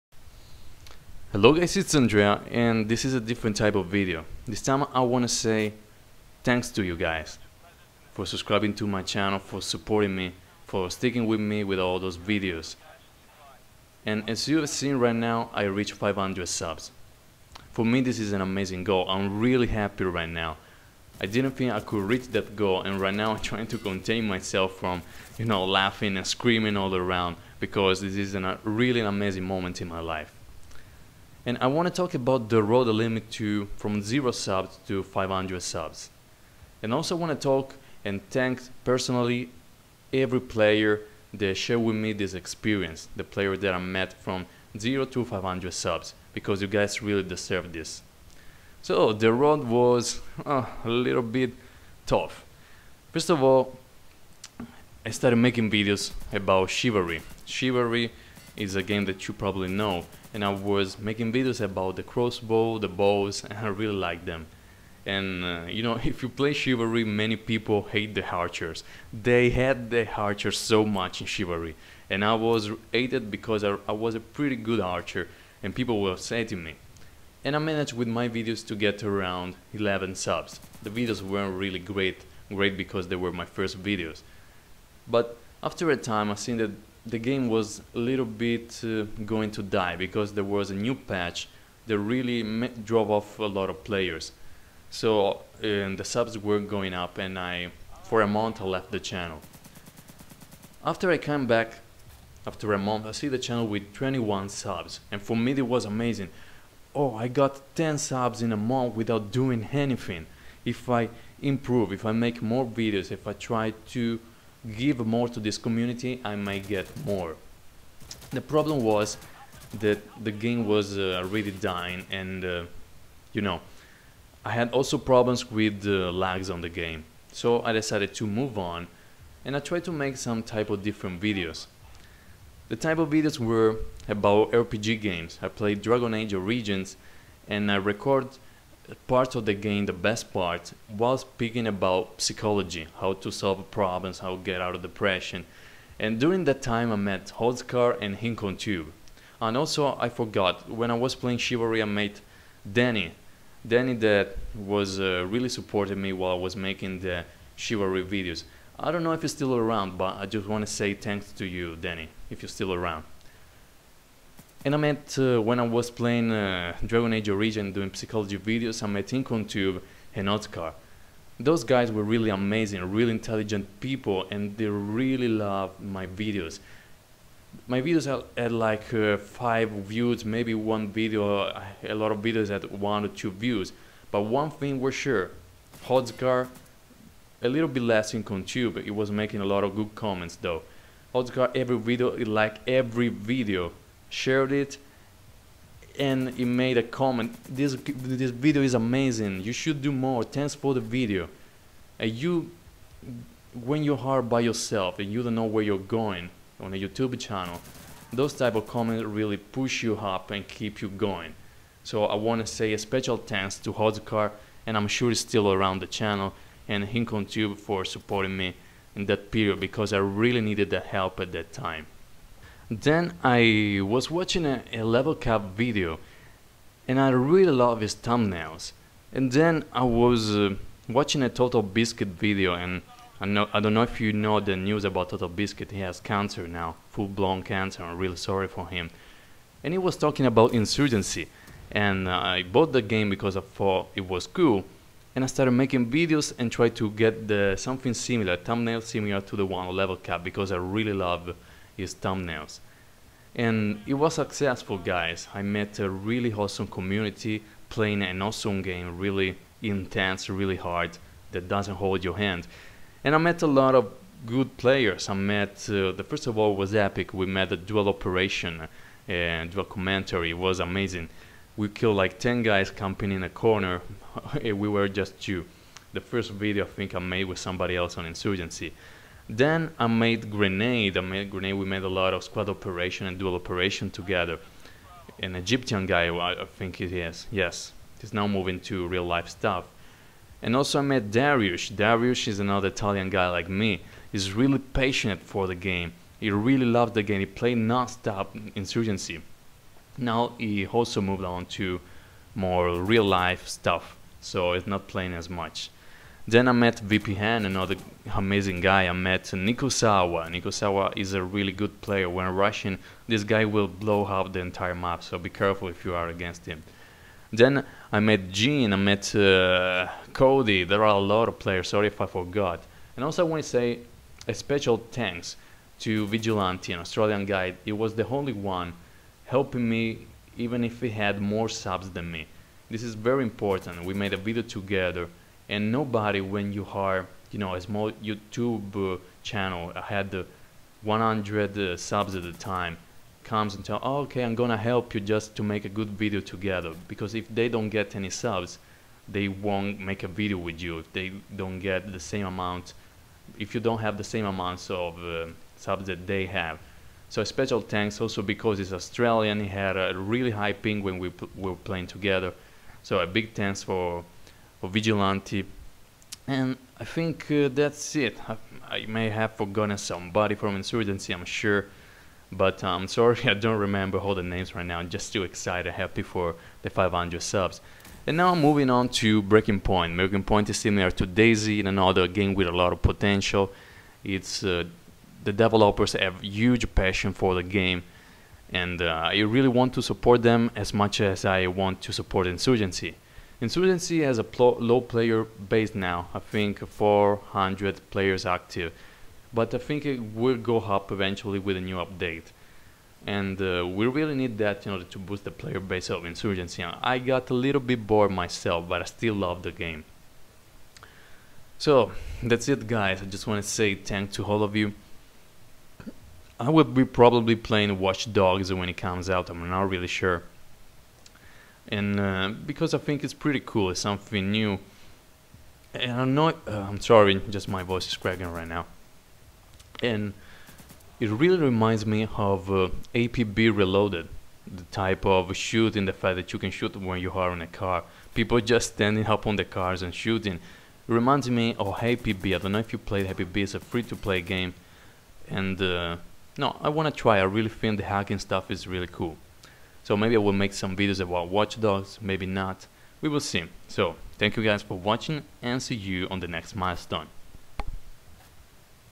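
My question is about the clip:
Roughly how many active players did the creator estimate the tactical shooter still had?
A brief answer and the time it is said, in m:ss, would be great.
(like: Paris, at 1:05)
400, at 6:36.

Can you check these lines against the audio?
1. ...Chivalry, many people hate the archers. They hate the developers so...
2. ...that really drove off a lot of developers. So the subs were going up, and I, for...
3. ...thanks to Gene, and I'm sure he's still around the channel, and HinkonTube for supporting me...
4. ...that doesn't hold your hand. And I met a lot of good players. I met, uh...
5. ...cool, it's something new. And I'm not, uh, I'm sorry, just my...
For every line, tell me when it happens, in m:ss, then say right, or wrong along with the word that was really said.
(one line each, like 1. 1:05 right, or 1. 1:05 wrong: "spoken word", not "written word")
1. 1:06 wrong: "archers", not "developers"
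2. 1:31 wrong: "players", not "developers"
3. 3:33 wrong: "Hodcar", not "Gene"
4. 4:21 right
5. 7:03 right.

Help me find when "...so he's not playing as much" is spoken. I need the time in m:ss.
5:04.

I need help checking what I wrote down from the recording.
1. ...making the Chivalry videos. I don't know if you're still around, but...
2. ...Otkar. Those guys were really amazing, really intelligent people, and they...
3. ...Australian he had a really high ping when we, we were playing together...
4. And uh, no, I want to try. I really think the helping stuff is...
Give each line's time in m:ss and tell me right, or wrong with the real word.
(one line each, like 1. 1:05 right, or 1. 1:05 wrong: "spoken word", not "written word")
1. 2:36 right
2. 2:50 right
3. 5:58 right
4. 7:25 wrong: "hacking", not "helping".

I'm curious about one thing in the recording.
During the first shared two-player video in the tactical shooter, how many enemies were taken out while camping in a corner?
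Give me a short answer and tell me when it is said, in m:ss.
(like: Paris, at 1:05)
10, at 4:32.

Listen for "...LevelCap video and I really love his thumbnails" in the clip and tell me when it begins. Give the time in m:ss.
3:44.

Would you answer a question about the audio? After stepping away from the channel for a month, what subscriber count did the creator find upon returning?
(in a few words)
21.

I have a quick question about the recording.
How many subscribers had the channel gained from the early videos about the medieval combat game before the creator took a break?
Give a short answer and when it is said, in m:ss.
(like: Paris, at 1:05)
11, at 1:19.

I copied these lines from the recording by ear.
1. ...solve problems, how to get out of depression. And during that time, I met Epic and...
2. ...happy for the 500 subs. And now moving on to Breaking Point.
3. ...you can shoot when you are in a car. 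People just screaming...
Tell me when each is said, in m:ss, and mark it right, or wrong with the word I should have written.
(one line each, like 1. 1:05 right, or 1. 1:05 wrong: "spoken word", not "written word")
1. 2:23 wrong: "Holzkar", not "Epic"
2. 6:15 right
3. 7:16 wrong: "standing", not "screaming".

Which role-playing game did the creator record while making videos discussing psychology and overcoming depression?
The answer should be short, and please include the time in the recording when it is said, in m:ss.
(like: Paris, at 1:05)
Dragon Age Origins, at 2:15.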